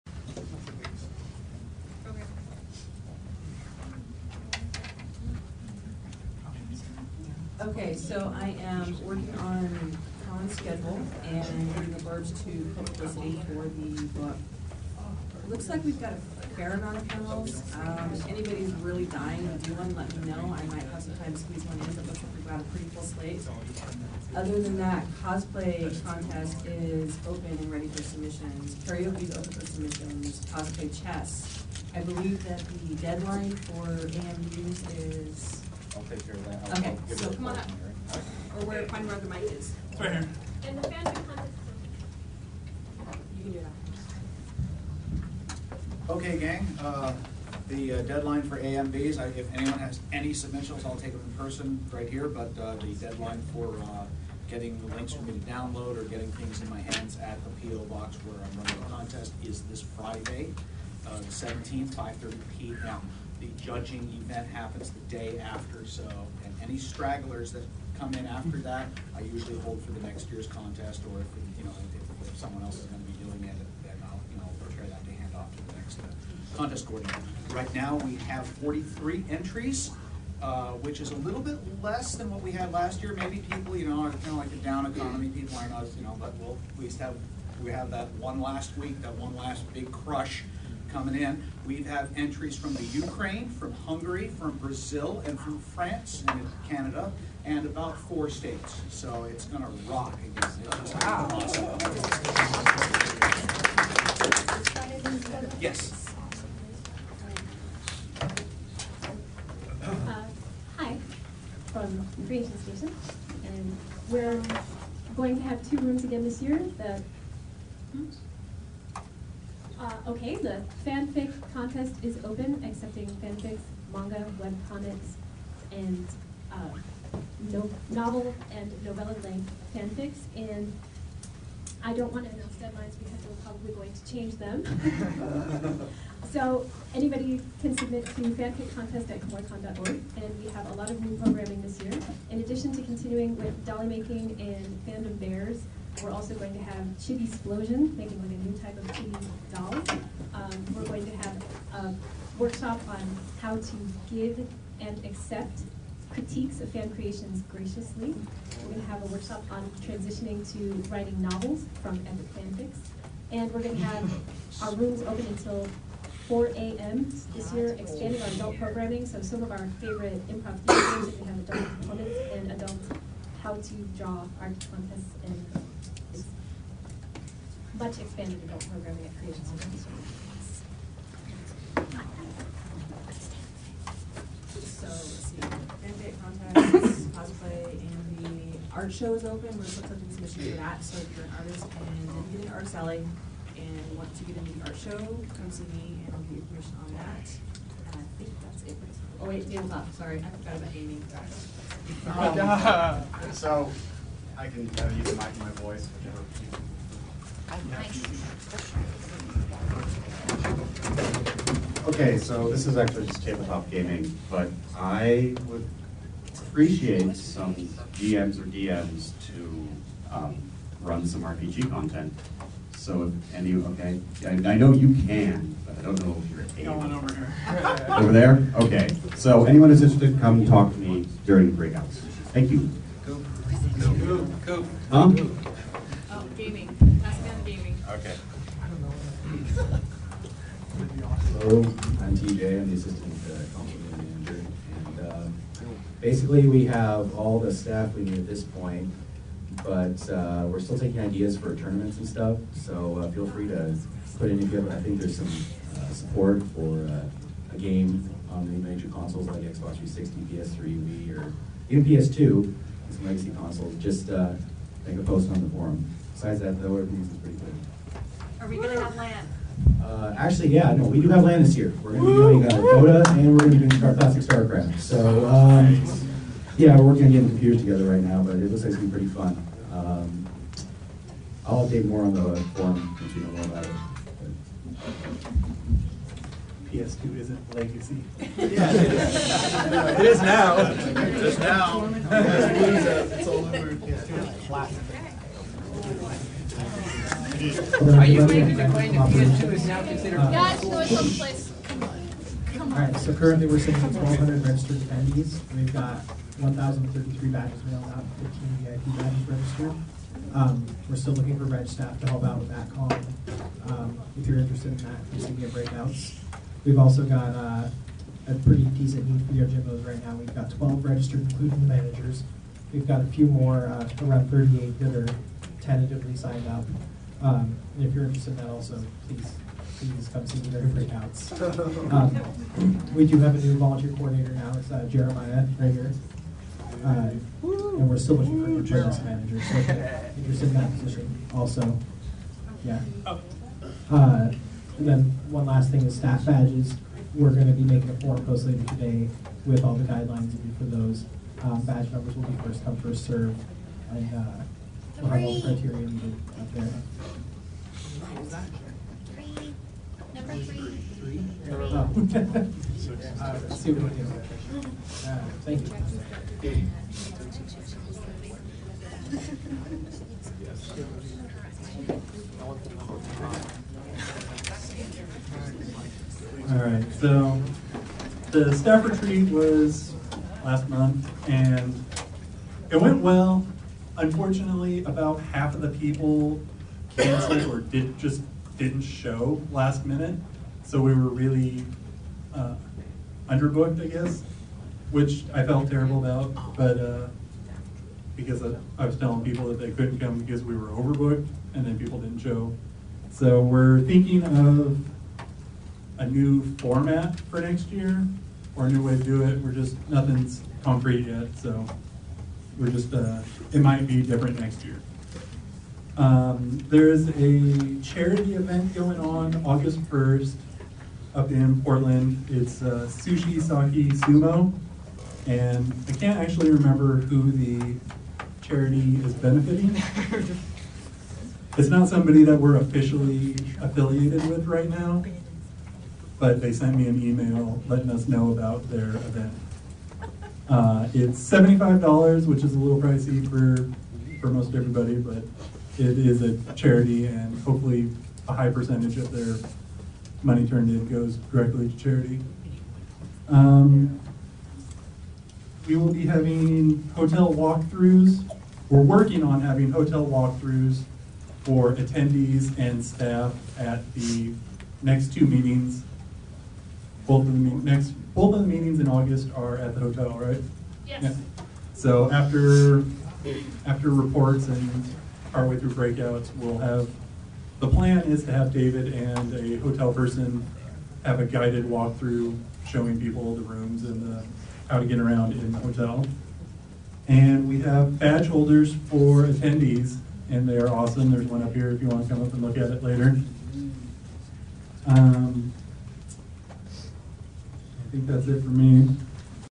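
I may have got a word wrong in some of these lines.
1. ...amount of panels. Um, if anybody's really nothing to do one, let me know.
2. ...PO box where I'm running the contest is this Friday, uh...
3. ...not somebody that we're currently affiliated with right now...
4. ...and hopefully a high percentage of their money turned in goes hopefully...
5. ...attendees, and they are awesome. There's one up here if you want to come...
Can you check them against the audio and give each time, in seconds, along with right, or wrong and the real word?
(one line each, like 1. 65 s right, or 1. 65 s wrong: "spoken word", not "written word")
1. 16 s wrong: "dying", not "nothing"
2. 57 s right
3. 431 s wrong: "officially", not "currently"
4. 447 s wrong: "directly", not "hopefully"
5. 489 s right.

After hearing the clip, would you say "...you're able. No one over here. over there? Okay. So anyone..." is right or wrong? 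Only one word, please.
right.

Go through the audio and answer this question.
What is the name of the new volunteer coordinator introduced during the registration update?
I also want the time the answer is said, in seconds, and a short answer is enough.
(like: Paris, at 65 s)
Jeremiah, at 334 s.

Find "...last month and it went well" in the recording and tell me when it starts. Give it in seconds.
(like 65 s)
380 s.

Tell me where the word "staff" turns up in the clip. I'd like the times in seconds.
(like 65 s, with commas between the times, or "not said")
247 s, 311 s, 345 s, 378 s, 462 s.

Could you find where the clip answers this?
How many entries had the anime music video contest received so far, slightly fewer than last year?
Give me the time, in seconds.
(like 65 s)
78 s.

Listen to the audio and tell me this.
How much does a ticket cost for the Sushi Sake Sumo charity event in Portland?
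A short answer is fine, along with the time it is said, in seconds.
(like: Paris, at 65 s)
$75, at 441 s.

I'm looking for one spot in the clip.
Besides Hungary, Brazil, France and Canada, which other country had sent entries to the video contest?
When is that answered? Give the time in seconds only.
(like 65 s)
92 s.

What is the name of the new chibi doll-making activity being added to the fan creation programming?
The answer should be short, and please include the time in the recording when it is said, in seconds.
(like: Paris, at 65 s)
Chibi Explosion, at 146 s.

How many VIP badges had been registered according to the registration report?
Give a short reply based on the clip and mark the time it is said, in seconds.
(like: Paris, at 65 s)
15, at 308 s.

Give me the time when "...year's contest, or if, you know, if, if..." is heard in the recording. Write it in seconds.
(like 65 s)
70 s.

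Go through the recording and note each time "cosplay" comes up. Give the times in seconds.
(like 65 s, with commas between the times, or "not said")
25 s, 30 s, 187 s.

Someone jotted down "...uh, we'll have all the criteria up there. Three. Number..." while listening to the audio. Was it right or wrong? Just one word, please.
right.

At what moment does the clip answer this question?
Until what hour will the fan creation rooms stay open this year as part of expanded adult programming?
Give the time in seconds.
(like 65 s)
166 s.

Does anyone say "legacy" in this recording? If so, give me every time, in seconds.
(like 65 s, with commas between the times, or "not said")
263 s, 287 s.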